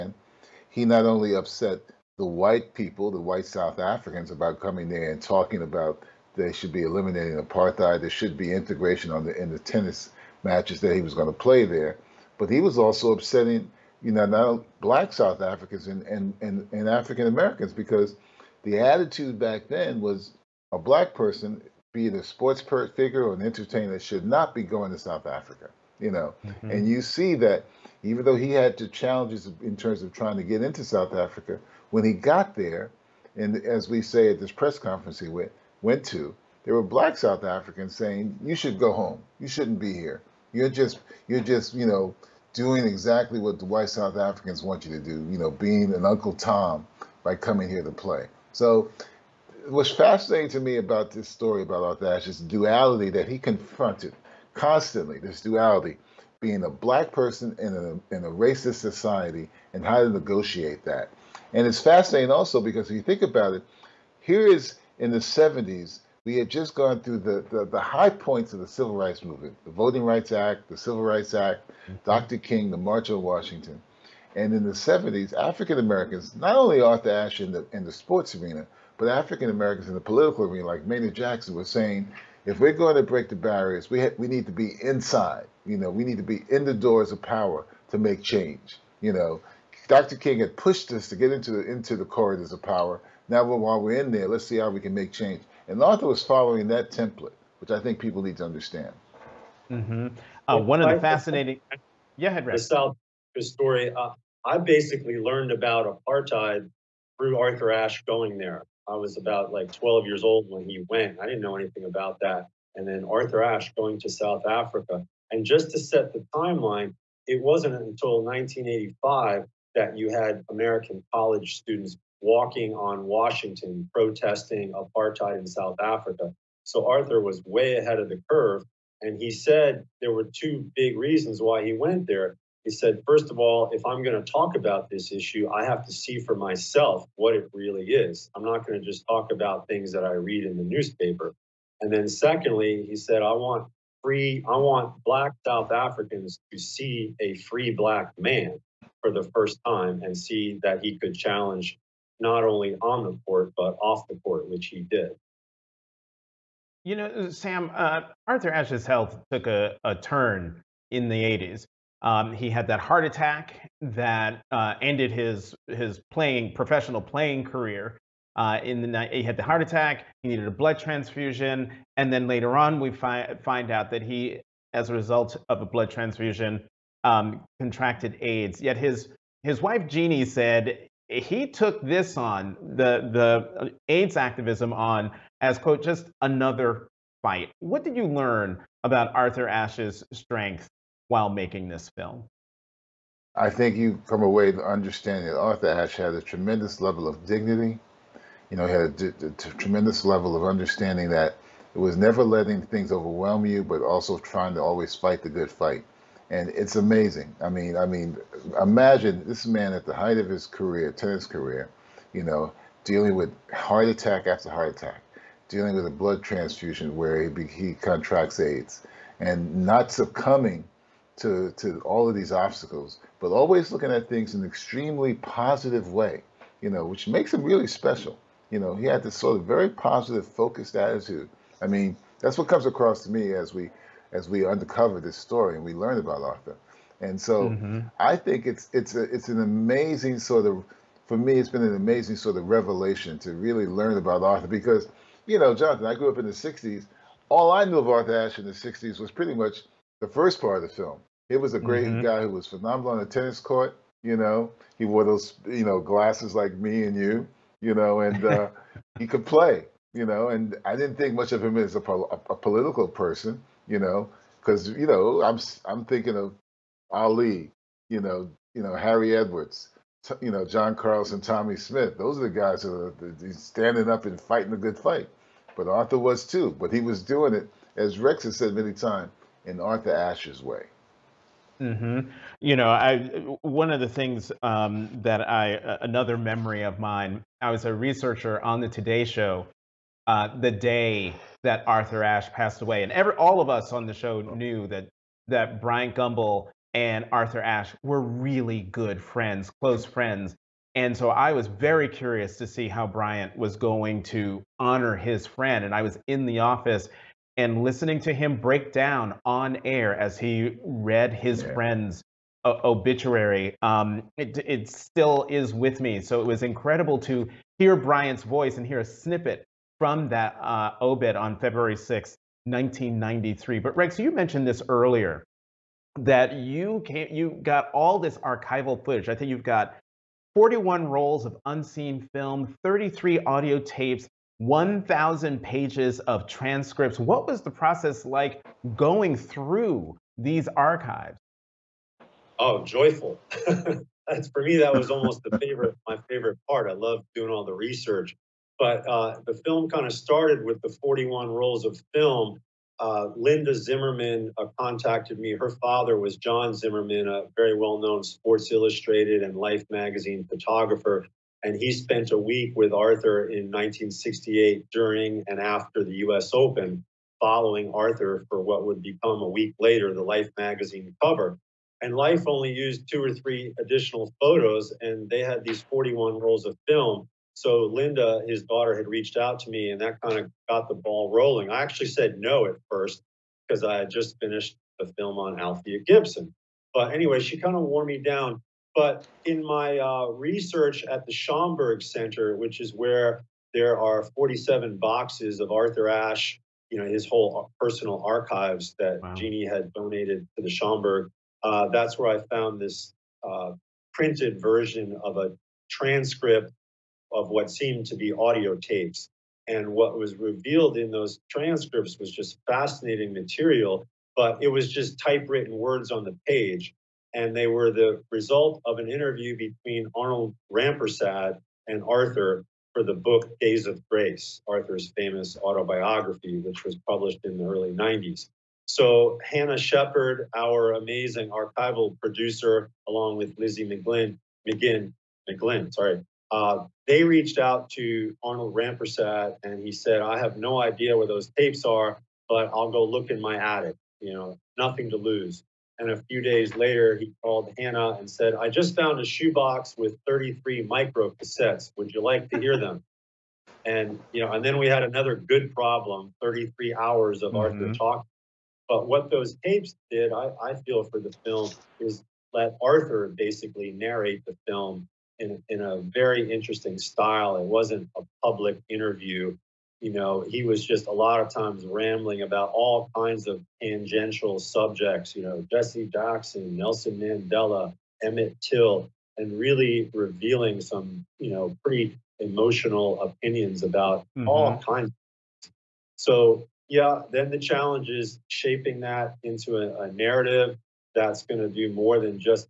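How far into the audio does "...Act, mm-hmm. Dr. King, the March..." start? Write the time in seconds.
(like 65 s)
71 s.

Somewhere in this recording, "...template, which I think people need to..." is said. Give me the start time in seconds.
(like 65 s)
96 s.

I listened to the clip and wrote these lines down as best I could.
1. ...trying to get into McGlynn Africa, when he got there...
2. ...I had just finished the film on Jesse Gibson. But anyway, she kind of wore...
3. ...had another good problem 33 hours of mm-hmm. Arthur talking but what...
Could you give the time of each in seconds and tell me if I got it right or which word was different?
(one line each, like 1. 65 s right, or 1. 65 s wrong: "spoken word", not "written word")
1. 30 s wrong: "South", not "McGlynn"
2. 383 s wrong: "Althea", not "Jesse"
3. 454 s right.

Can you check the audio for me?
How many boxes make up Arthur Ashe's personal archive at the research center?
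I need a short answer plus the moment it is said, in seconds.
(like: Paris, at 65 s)
47, at 394 s.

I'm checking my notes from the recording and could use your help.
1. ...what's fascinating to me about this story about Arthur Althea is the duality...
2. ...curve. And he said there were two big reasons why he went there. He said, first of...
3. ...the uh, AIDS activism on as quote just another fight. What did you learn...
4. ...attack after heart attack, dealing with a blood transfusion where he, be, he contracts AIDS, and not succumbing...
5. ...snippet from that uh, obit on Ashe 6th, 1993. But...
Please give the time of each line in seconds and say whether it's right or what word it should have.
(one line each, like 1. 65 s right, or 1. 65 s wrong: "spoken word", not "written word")
1. 49 s wrong: "Ashe", not "Althea"
2. 128 s right
3. 183 s right
4. 213 s right
5. 318 s wrong: "February", not "Ashe".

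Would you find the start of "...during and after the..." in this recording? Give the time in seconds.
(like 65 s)
364 s.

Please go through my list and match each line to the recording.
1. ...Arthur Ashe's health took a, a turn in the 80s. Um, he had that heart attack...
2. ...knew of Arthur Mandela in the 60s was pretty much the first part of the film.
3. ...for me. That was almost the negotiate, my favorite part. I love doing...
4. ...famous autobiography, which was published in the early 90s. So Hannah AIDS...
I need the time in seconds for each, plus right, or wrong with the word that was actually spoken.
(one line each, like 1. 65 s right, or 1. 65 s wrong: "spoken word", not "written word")
1. 158 s right
2. 247 s wrong: "Ashe", not "Mandela"
3. 344 s wrong: "favorite", not "negotiate"
4. 424 s wrong: "Shepard", not "AIDS".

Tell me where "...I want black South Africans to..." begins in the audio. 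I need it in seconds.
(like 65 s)
144 s.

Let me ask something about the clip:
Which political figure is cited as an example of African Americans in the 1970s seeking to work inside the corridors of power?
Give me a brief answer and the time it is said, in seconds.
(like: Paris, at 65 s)
Maynard Jackson, at 80 s.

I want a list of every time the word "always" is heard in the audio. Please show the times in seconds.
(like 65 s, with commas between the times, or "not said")
204 s, 223 s.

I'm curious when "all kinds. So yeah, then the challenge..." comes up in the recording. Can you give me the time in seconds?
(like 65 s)
484 s.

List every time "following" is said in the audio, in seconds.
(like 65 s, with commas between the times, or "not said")
96 s, 367 s.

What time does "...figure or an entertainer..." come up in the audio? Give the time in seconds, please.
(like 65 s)
22 s.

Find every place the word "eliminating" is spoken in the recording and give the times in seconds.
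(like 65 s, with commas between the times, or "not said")
6 s.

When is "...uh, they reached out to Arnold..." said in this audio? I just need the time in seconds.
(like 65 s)
436 s.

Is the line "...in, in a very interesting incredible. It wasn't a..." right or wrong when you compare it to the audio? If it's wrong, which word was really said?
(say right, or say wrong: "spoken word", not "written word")
wrong: "style", not "incredible".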